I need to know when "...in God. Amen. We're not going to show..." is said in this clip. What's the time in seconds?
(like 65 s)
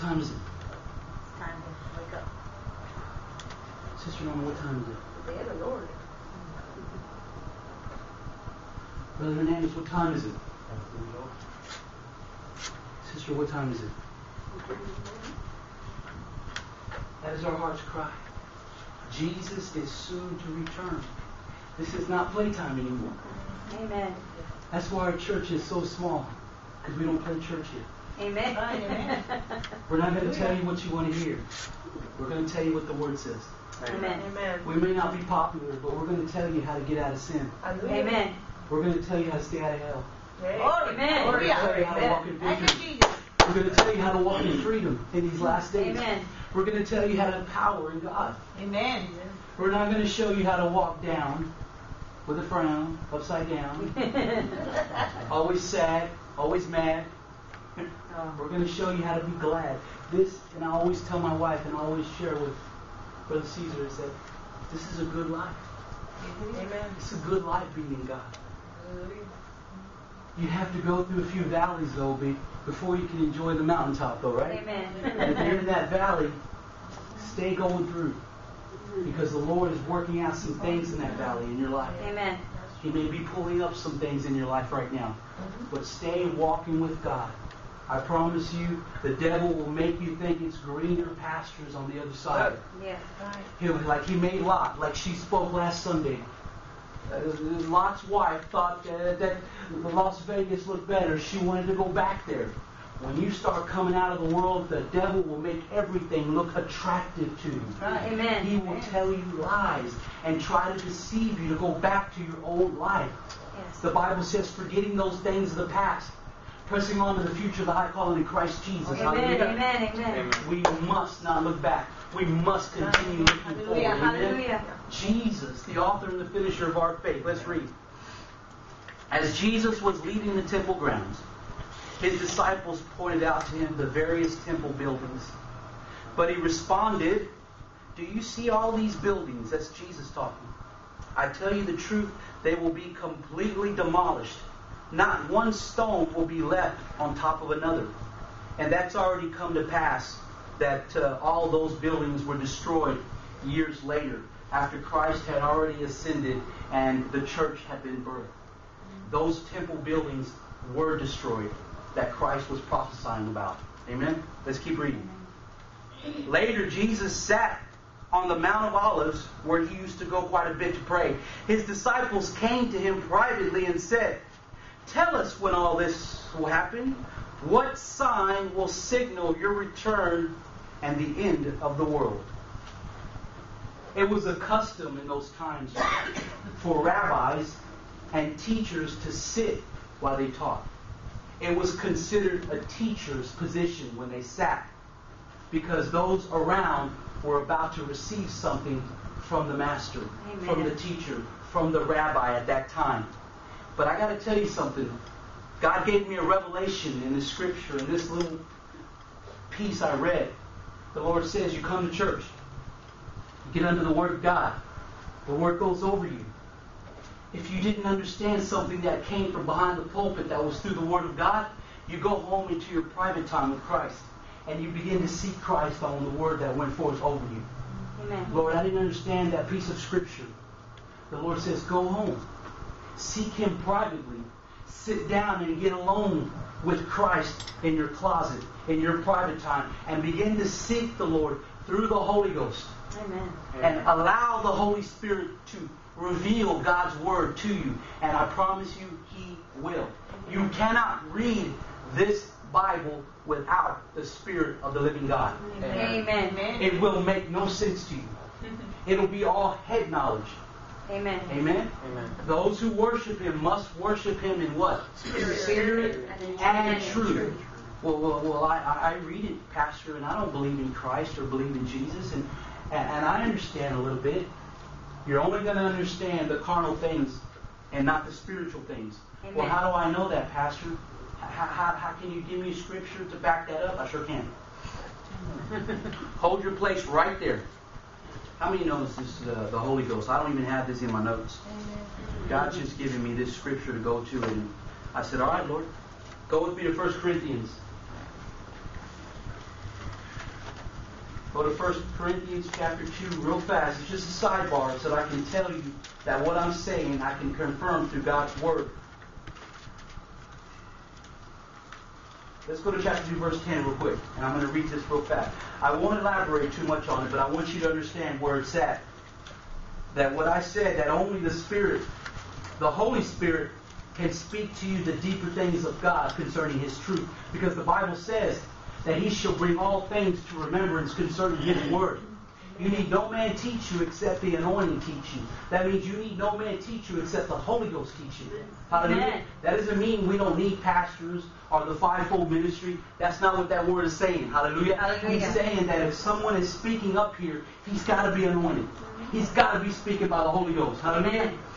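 47 s.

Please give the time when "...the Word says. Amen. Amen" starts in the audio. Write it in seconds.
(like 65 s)
32 s.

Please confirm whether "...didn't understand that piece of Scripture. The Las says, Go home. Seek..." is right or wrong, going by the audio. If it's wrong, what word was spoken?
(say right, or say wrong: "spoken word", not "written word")
wrong: "Lord", not "Las".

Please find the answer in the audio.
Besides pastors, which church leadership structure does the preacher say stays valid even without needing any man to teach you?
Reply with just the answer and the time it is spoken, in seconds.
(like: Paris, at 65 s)
fivefold ministry, at 341 s.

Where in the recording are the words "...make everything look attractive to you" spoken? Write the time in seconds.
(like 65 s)
105 s.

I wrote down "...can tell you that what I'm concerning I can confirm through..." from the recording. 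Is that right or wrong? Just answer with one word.
wrong.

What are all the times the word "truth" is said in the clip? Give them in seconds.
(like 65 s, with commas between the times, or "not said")
141 s, 266 s, 326 s.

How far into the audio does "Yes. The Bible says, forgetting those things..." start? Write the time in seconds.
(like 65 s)
113 s.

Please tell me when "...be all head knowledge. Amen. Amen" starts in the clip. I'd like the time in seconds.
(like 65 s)
259 s.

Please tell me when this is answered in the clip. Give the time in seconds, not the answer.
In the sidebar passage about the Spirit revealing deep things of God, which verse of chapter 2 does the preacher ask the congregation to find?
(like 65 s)
313 s.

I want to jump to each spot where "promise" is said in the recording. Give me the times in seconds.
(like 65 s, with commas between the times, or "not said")
87 s, 248 s.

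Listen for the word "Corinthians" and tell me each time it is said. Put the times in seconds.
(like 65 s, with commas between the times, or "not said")
296 s, 301 s.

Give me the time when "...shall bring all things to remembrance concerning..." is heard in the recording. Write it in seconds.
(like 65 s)
329 s.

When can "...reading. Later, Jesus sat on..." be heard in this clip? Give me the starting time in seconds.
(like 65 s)
164 s.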